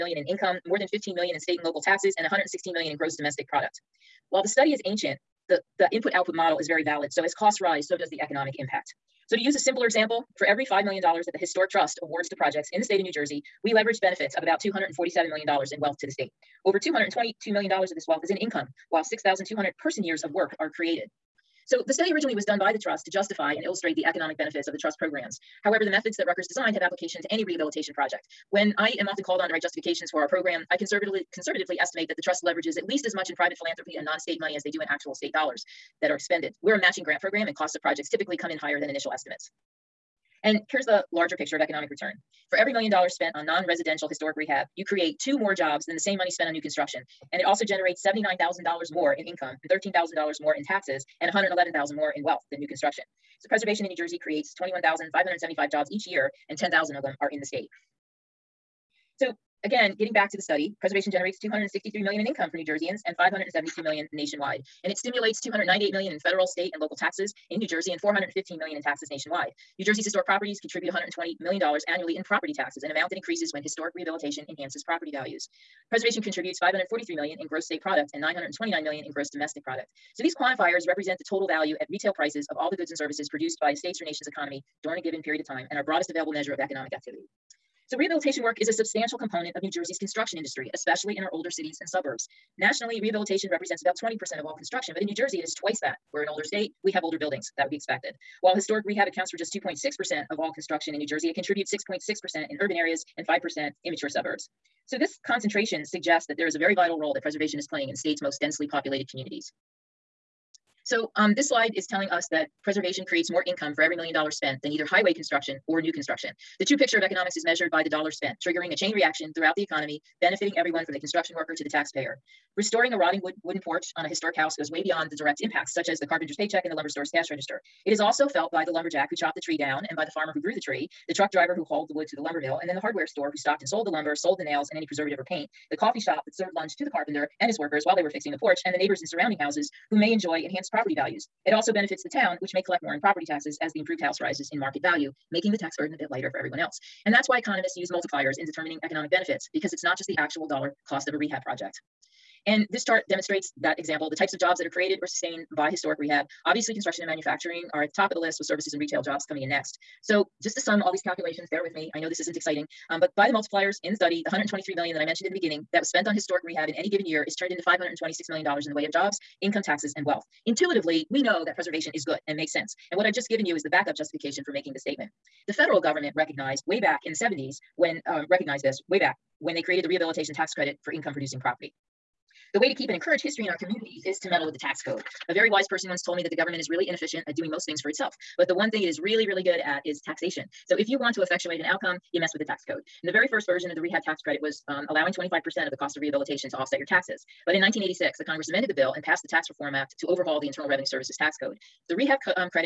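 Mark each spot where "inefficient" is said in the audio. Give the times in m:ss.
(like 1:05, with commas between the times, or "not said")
3:06.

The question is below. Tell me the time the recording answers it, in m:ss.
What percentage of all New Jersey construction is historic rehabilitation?
1:39.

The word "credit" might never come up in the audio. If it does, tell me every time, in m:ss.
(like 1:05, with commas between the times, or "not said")
3:00, 3:14.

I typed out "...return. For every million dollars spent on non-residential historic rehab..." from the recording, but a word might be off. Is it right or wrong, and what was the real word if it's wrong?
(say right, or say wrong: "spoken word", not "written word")
right.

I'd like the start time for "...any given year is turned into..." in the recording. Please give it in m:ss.
2:46.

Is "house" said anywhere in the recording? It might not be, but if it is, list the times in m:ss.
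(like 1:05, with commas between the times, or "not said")
2:04, 2:19, 2:24.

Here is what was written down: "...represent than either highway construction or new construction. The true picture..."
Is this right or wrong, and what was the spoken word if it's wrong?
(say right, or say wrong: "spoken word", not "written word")
wrong: "spent", not "represent".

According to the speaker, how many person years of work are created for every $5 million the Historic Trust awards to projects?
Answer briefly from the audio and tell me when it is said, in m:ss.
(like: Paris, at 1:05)
6,200, at 0:19.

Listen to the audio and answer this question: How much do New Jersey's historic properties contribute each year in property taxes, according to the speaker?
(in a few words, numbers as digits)
$120 million.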